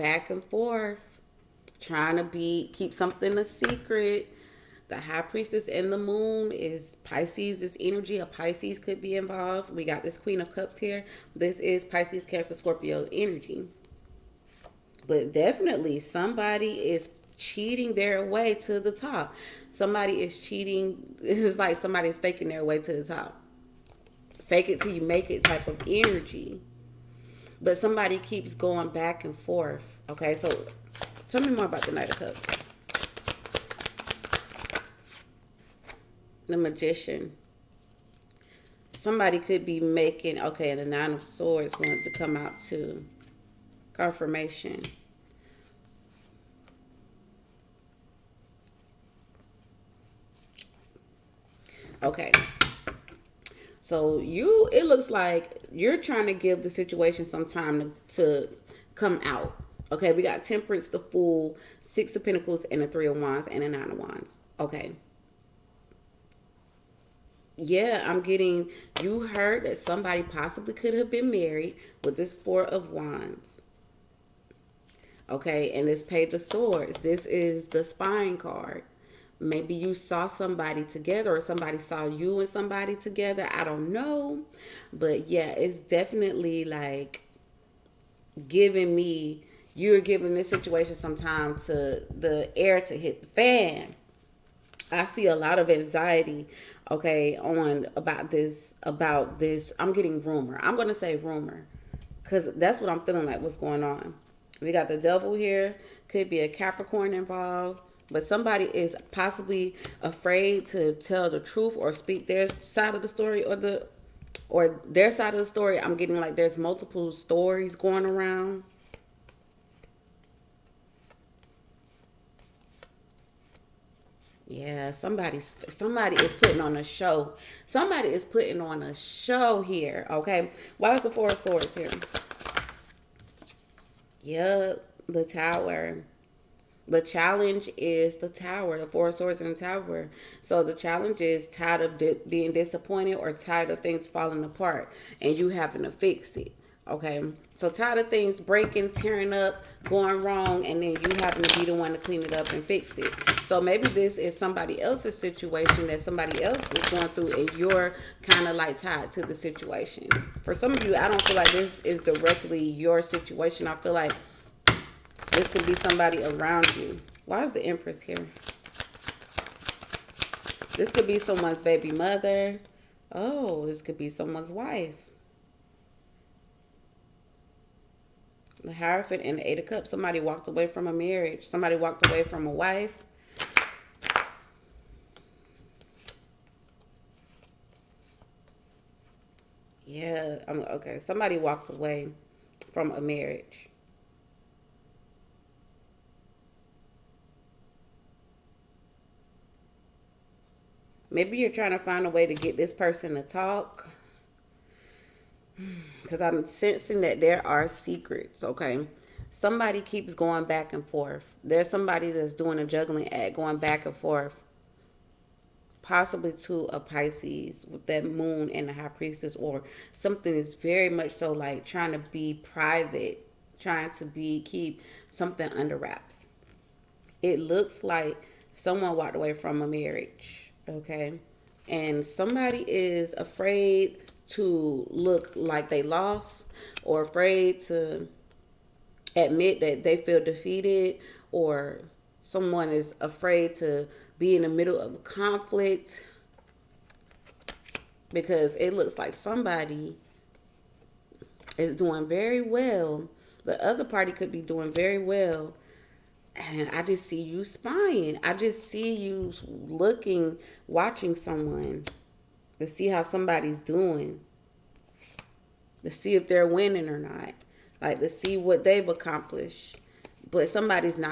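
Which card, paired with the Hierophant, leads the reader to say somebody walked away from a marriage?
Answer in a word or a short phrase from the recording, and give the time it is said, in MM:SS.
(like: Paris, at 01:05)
Eight of Cups, at 02:59.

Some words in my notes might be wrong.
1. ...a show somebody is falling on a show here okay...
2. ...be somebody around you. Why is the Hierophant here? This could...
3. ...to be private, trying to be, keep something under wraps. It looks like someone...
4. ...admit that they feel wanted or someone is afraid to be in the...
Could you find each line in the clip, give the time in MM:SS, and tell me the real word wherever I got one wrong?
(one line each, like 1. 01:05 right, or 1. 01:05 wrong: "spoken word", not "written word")
1. 02:06 wrong: "putting", not "falling"
2. 02:45 wrong: "Empress", not "Hierophant"
3. 03:41 right
4. 03:59 wrong: "defeated", not "wanted".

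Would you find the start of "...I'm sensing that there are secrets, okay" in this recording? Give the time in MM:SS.
03:26.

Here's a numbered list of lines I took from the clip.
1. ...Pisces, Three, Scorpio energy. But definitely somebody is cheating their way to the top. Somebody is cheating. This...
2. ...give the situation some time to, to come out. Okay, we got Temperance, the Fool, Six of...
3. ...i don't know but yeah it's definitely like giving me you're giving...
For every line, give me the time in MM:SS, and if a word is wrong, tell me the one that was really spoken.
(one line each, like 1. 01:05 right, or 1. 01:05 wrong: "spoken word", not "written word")
1. 00:11 wrong: "Cancer", not "Three"
2. 00:56 right
3. 01:23 right.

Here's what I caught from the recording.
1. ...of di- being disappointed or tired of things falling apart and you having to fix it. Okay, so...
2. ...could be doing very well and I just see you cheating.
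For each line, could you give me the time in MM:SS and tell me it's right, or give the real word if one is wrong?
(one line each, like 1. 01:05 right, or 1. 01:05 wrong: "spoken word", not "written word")
1. 02:21 right
2. 04:14 wrong: "spying", not "cheating".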